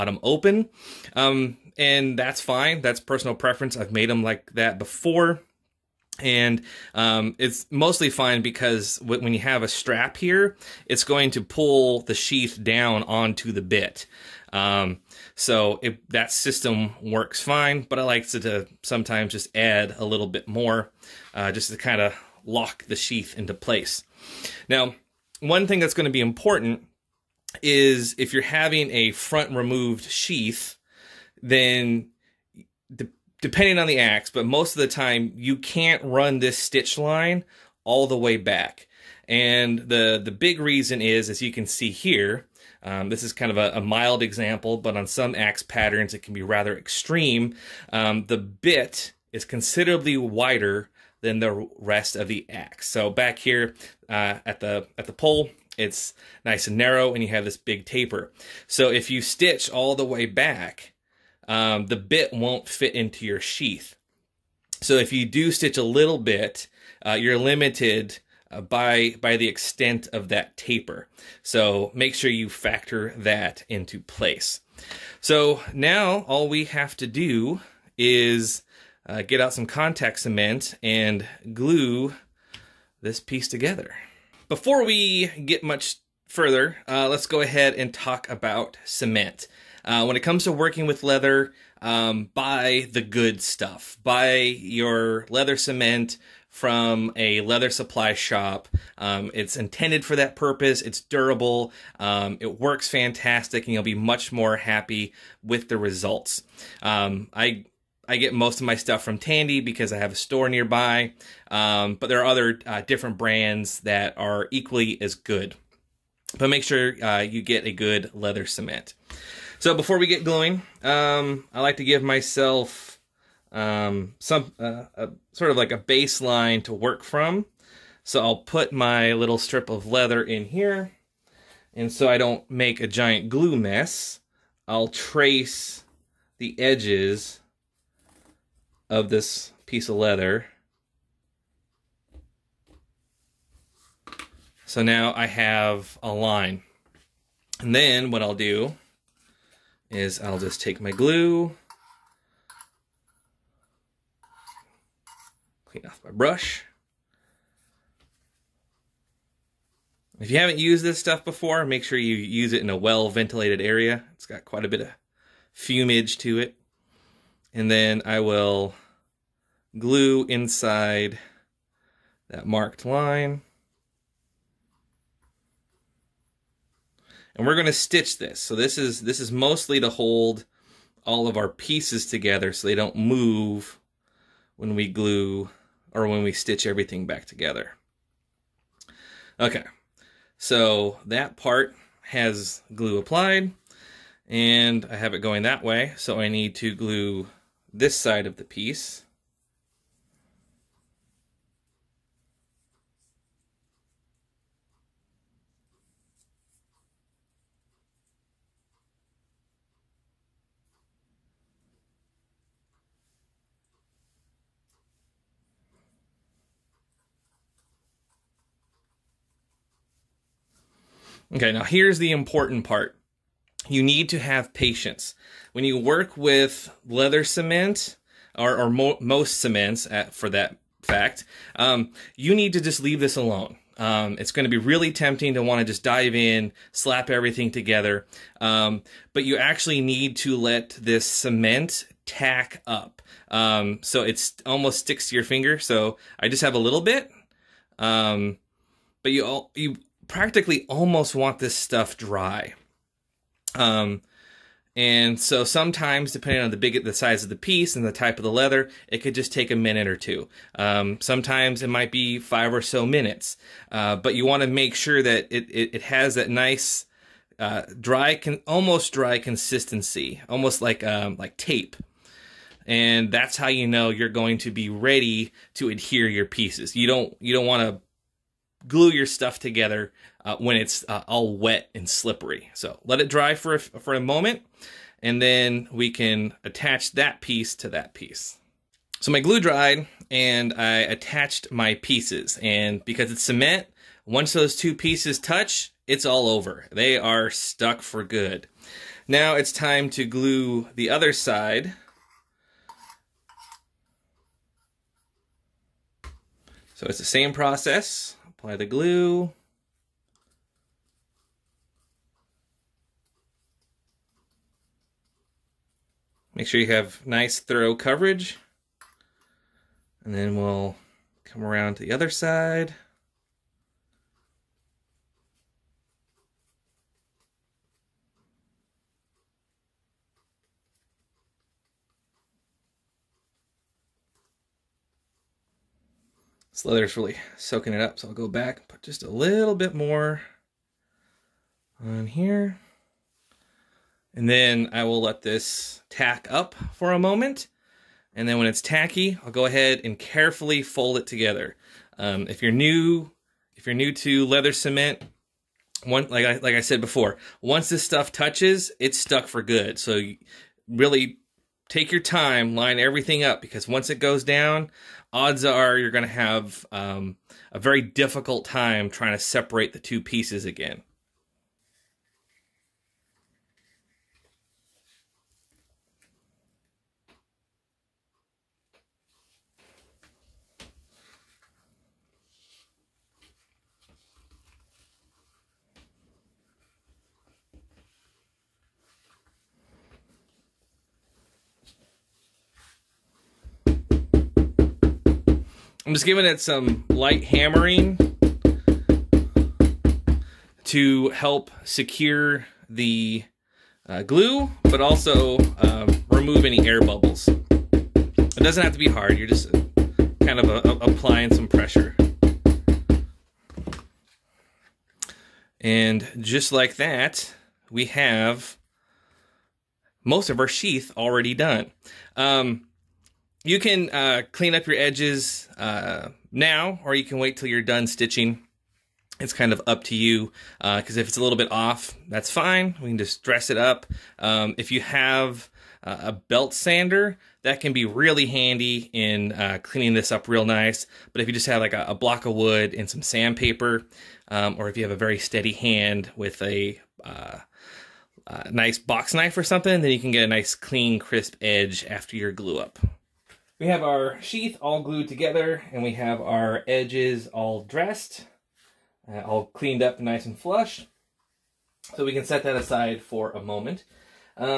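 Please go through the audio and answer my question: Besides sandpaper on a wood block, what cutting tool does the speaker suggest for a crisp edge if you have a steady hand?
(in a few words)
Box knife.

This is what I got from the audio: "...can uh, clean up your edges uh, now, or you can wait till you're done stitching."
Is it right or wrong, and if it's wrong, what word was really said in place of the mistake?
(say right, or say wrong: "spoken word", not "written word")
right.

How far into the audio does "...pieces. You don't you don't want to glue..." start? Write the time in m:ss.
4:36.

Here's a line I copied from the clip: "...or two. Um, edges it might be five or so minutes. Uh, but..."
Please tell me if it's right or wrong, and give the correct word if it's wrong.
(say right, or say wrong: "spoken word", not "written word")
wrong: "sometimes", not "edges".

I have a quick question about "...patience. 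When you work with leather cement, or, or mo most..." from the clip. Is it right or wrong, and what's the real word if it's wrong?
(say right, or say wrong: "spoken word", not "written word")
right.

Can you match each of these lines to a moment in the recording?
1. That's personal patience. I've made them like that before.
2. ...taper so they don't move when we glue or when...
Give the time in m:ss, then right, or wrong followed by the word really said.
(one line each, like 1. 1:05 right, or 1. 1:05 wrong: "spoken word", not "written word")
1. 0:02 wrong: "preference", not "patience"
2. 3:02 wrong: "together", not "taper".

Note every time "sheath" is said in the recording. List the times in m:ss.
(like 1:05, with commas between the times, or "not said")
0:12, 0:22, 0:30, 1:03, 7:00, 7:34.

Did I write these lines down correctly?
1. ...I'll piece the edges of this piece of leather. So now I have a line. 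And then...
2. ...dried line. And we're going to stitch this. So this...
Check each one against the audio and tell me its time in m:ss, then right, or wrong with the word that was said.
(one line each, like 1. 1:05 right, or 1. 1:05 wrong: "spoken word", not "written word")
1. 2:14 wrong: "trace", not "piece"
2. 2:52 wrong: "marked", not "dried".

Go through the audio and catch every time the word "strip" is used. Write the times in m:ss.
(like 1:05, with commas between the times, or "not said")
2:09.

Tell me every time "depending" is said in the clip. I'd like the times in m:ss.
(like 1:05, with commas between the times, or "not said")
0:33, 4:16.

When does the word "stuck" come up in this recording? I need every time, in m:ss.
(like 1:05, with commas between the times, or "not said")
4:57, 5:58.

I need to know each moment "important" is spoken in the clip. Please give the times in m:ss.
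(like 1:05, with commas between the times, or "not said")
0:26, 3:42.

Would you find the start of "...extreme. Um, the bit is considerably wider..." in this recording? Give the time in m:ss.
0:46.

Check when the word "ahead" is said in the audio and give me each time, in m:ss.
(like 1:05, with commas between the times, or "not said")
1:27, 5:49.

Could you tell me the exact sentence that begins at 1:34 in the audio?
Buy your leather cement from a leather supply shop.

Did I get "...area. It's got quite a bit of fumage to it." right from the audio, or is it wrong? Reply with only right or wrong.
right.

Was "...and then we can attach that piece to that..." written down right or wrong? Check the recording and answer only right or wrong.
right.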